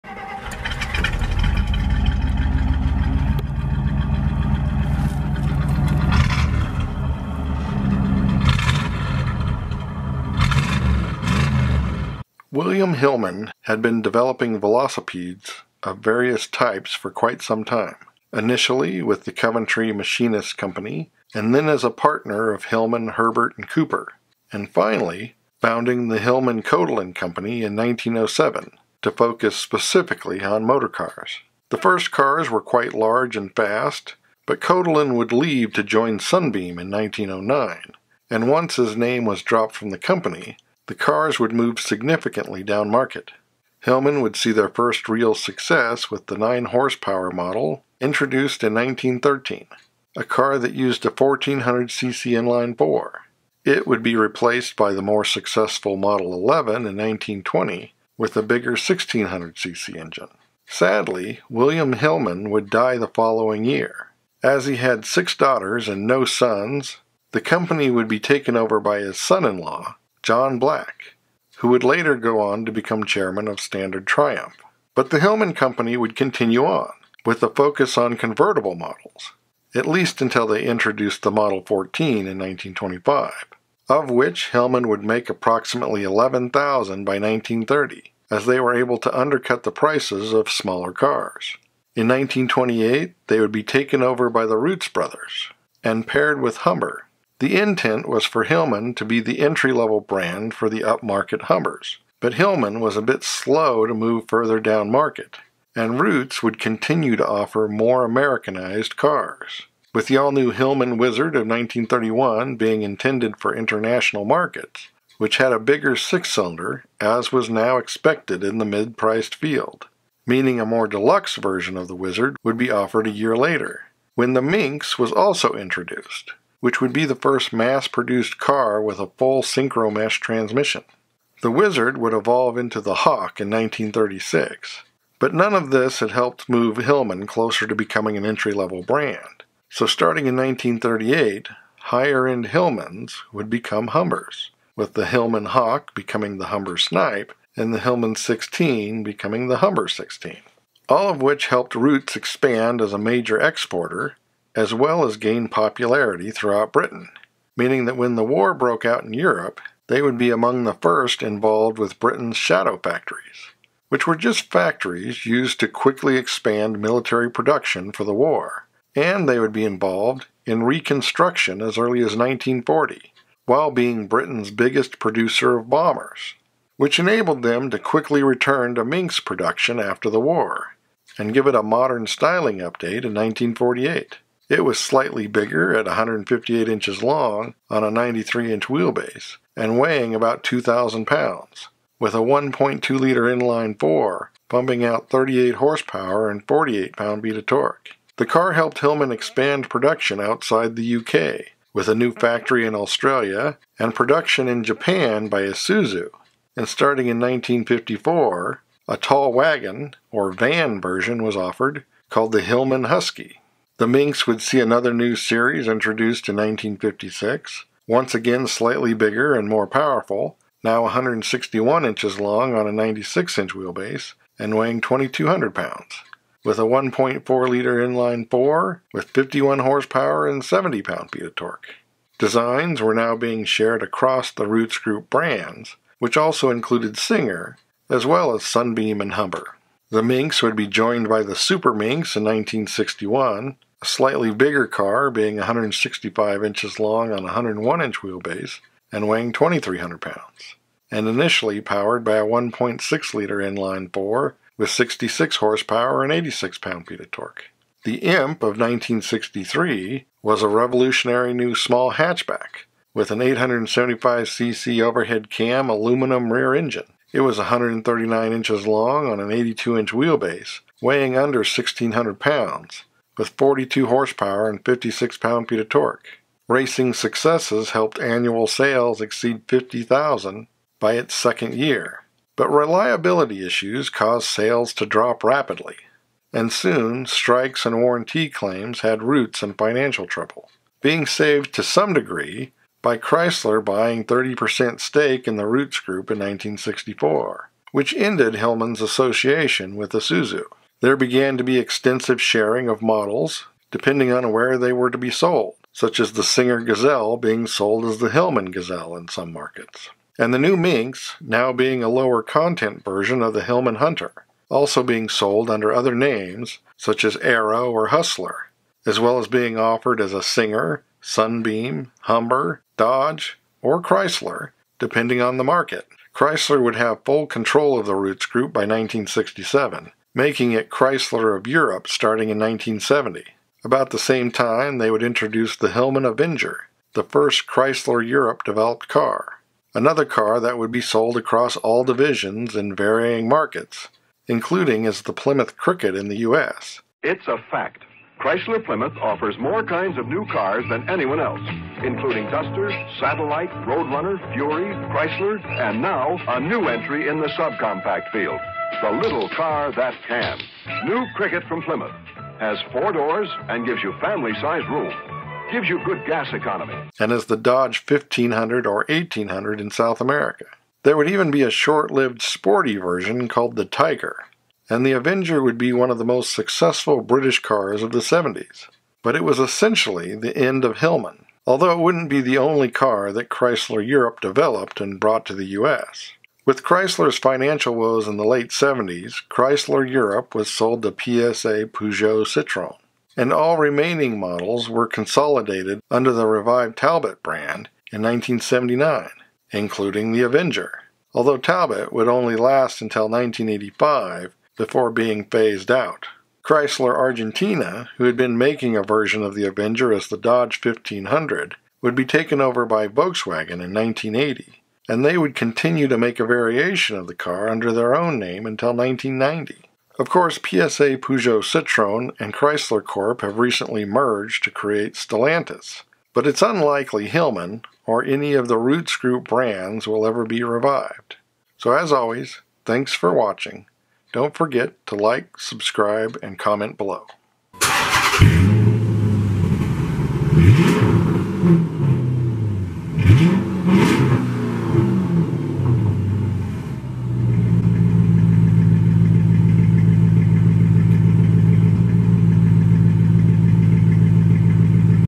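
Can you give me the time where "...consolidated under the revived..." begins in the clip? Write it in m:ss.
6:34.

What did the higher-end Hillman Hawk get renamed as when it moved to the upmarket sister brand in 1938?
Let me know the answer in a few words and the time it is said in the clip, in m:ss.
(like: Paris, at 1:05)
Humber Snipe, at 2:26.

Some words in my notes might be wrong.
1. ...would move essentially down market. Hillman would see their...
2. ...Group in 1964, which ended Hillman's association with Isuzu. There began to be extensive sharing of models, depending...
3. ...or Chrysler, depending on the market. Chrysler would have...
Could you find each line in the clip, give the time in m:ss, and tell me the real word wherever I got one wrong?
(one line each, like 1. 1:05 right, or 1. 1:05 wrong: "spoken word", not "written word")
1. 0:41 wrong: "significantly", not "essentially"
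2. 4:55 right
3. 5:23 right.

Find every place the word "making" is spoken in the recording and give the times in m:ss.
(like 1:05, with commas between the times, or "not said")
5:30, 6:48.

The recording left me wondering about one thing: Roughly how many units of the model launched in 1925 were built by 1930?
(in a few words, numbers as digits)
11,000.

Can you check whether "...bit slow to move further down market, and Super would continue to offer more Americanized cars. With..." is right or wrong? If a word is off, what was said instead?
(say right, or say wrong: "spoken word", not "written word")
wrong: "Rootes", not "Super".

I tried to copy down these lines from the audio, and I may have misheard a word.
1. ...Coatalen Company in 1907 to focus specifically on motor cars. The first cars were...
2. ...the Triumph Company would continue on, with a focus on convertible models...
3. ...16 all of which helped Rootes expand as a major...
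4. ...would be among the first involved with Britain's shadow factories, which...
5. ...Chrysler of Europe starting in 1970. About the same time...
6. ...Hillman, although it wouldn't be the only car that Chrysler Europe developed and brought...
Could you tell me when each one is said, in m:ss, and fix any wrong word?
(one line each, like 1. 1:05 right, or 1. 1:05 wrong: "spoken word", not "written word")
1. 0:26 right
2. 1:15 wrong: "Hillman", not "Triumph"
3. 2:29 right
4. 2:40 right
5. 5:30 right
6. 6:20 right.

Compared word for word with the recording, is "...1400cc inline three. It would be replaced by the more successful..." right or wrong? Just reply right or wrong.
wrong.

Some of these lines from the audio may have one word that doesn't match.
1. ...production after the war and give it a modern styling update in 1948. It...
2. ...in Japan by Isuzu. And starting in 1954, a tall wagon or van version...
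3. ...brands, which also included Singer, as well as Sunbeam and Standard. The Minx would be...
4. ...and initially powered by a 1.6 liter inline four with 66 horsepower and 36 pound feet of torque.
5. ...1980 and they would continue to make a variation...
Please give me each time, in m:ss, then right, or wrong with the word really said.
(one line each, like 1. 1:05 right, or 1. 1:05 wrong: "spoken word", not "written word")
1. 2:59 right
2. 3:24 right
3. 3:55 wrong: "Humber", not "Standard"
4. 4:10 wrong: "86", not "36"
5. 6:53 right.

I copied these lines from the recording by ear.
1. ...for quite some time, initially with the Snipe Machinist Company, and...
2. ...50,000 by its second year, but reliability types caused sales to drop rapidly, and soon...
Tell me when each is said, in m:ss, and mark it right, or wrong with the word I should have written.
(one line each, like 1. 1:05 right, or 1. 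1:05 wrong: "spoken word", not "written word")
1. 0:16 wrong: "Coventry", not "Snipe"
2. 4:39 wrong: "issues", not "types".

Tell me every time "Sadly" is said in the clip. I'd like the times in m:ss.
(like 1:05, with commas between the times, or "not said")
1:00.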